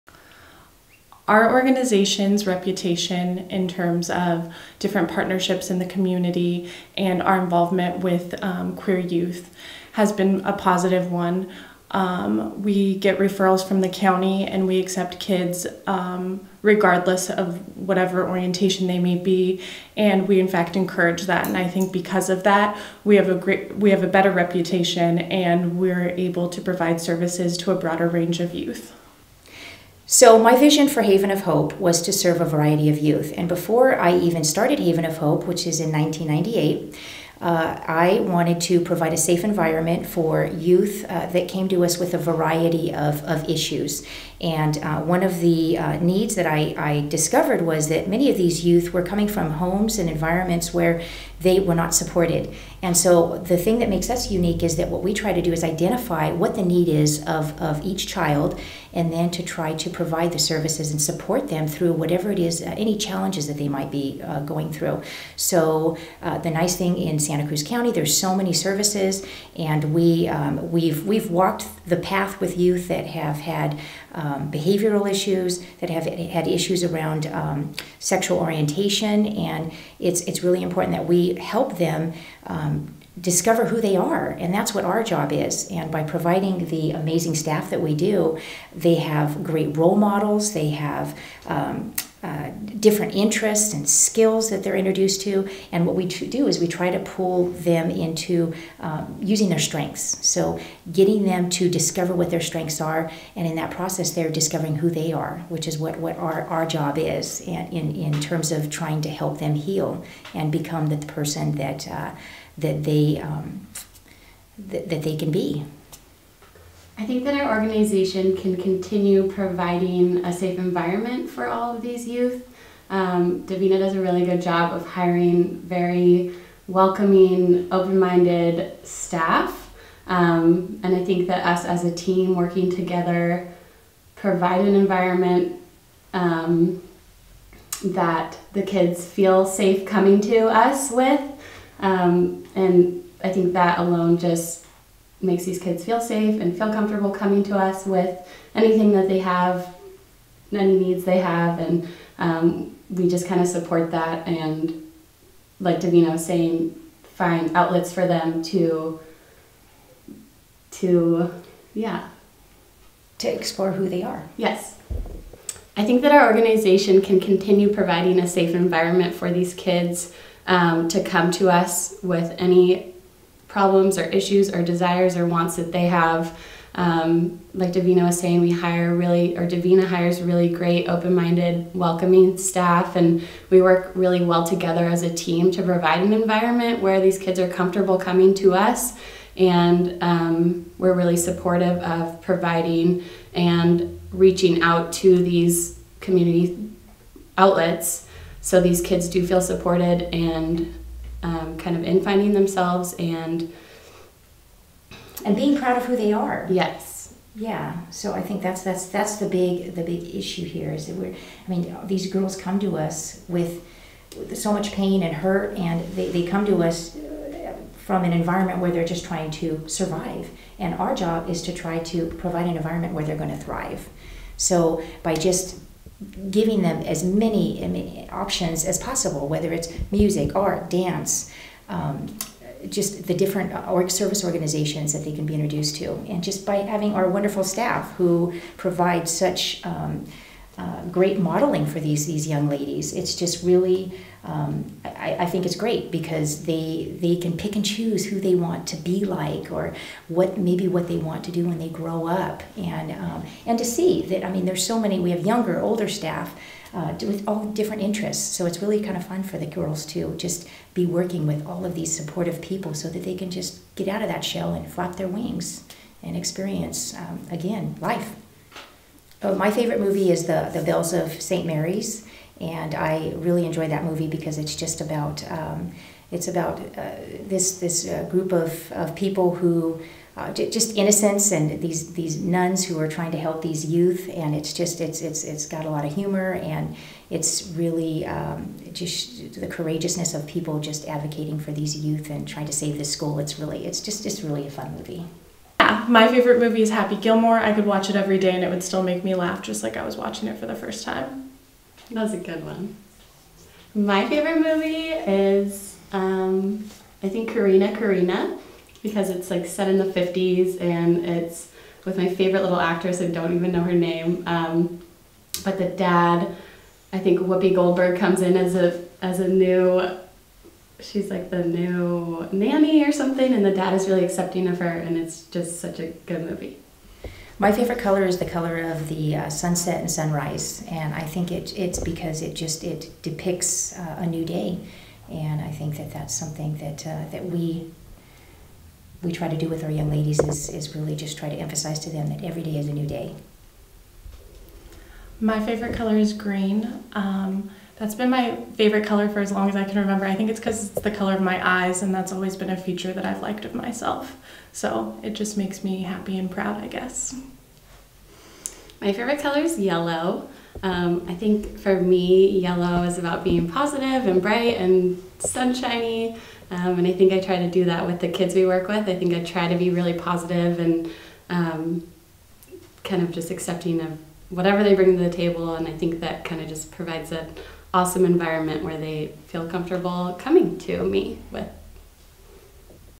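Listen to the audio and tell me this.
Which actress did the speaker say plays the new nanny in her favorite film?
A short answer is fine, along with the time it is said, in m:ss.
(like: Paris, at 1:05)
Whoopi Goldberg, at 5:17.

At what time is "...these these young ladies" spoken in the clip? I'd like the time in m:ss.
4:01.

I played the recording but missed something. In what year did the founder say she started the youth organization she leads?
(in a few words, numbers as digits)
1998.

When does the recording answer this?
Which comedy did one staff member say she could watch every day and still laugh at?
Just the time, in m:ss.
4:56.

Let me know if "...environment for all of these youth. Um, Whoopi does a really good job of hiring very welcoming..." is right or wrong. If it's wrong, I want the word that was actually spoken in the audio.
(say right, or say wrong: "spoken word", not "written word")
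wrong: "Davina", not "Whoopi".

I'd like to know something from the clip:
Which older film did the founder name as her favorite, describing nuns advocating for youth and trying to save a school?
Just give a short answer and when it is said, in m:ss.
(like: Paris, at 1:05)
The Bells of St. Mary's, at 4:30.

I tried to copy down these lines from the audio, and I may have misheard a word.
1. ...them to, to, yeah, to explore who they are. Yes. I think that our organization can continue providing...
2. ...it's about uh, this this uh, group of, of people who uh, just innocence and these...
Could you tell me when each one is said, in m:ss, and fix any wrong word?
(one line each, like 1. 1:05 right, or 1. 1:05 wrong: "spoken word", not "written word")
1. 2:38 right
2. 4:36 right.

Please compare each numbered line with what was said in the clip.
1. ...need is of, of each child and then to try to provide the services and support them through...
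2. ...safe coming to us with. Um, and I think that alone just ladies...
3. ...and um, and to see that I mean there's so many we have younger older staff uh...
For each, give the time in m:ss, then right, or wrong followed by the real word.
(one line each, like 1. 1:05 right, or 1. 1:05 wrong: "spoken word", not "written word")
1. 0:56 right
2. 2:19 wrong: "makes", not "ladies"
3. 4:12 right.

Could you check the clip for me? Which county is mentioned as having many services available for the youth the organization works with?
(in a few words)
Santa Cruz County.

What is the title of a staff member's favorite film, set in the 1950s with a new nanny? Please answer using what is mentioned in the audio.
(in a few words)
Corrina Corrina.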